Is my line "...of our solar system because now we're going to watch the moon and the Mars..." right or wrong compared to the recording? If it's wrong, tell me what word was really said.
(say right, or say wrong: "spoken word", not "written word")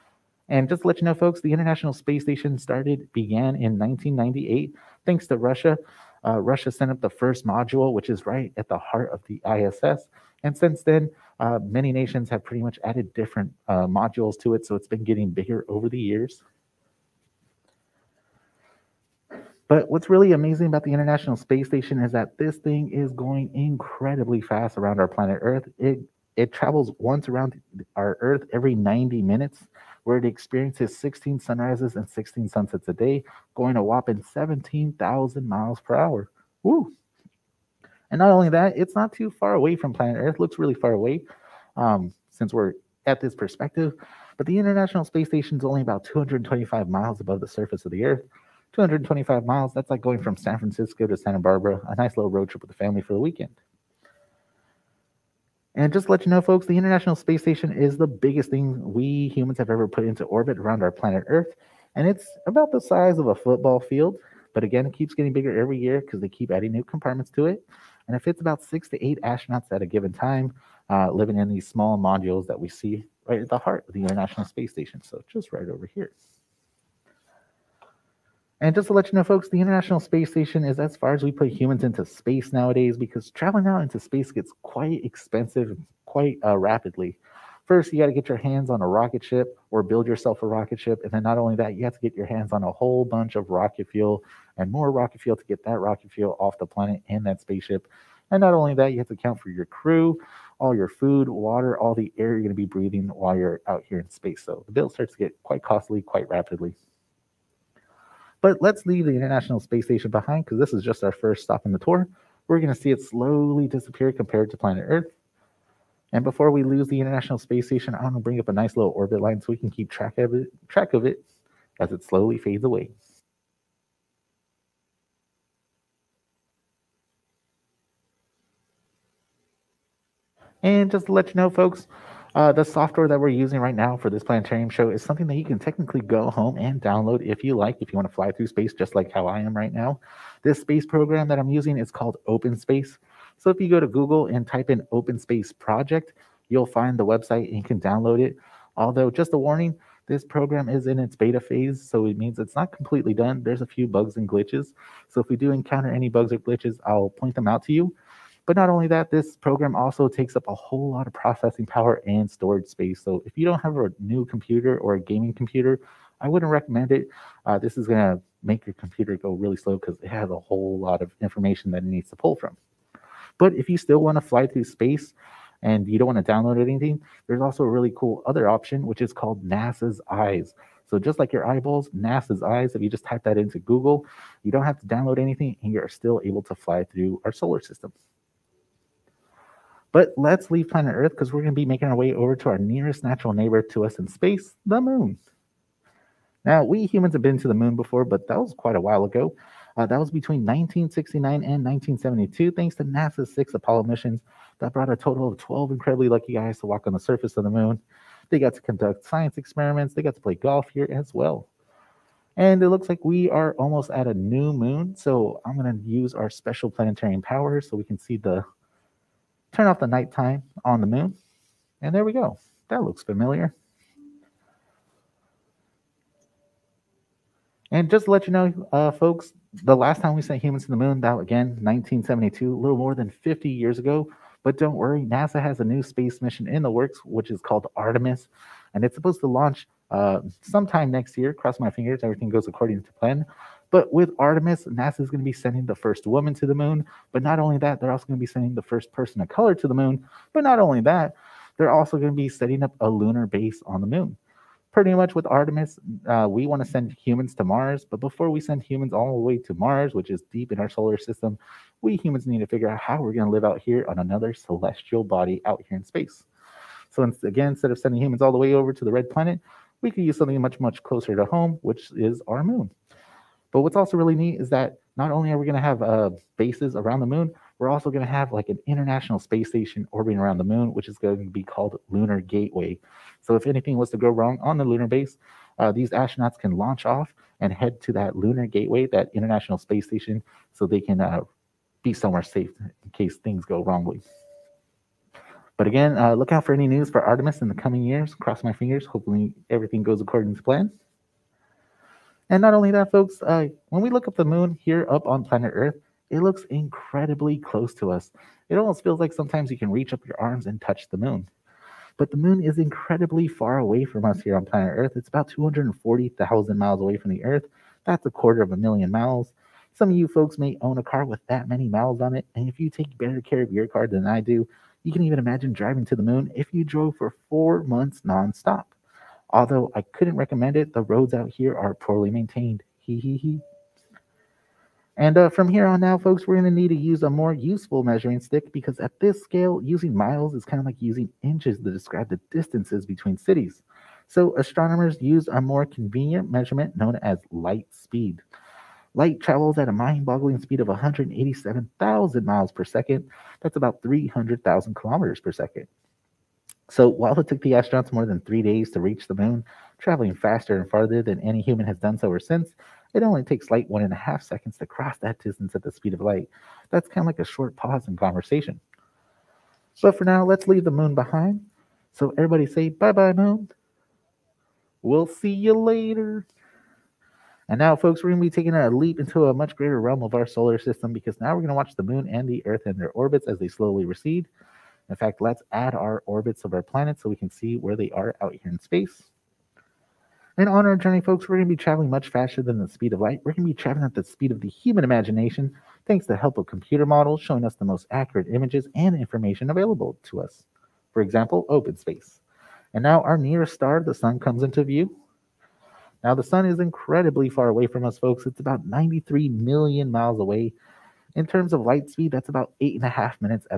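wrong: "Earth", not "Mars".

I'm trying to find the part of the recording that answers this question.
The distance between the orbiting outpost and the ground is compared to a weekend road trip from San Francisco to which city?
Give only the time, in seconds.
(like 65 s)
51 s.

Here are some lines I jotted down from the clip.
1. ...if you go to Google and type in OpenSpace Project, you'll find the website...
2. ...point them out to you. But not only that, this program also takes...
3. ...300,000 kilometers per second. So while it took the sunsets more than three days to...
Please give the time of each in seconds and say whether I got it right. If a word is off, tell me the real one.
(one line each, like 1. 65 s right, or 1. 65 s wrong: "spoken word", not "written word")
1. 143 s right
2. 157 s right
3. 353 s wrong: "astronauts", not "sunsets".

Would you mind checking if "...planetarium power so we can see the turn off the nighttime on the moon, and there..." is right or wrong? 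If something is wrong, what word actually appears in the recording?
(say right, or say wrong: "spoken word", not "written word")
right.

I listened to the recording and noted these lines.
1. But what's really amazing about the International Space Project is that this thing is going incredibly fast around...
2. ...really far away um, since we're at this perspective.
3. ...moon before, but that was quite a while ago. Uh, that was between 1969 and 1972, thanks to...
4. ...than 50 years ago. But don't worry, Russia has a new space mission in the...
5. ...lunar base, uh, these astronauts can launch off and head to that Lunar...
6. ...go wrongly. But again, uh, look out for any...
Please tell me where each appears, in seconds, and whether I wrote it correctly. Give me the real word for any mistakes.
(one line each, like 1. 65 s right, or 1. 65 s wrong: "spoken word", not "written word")
1. 19 s wrong: "Station", not "Project"
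2. 40 s right
3. 197 s right
4. 232 s wrong: "NASA", not "Russia"
5. 284 s right
6. 293 s right.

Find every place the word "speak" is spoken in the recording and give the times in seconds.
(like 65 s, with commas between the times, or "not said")
not said.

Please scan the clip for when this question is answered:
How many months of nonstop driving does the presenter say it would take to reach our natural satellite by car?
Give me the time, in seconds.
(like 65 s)
327 s.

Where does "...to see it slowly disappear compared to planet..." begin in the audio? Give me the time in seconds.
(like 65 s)
112 s.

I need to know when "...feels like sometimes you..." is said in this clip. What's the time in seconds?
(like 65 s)
308 s.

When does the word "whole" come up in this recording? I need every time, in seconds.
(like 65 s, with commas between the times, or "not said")
92 s, 160 s, 170 s.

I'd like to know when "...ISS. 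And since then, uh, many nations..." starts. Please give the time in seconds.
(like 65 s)
9 s.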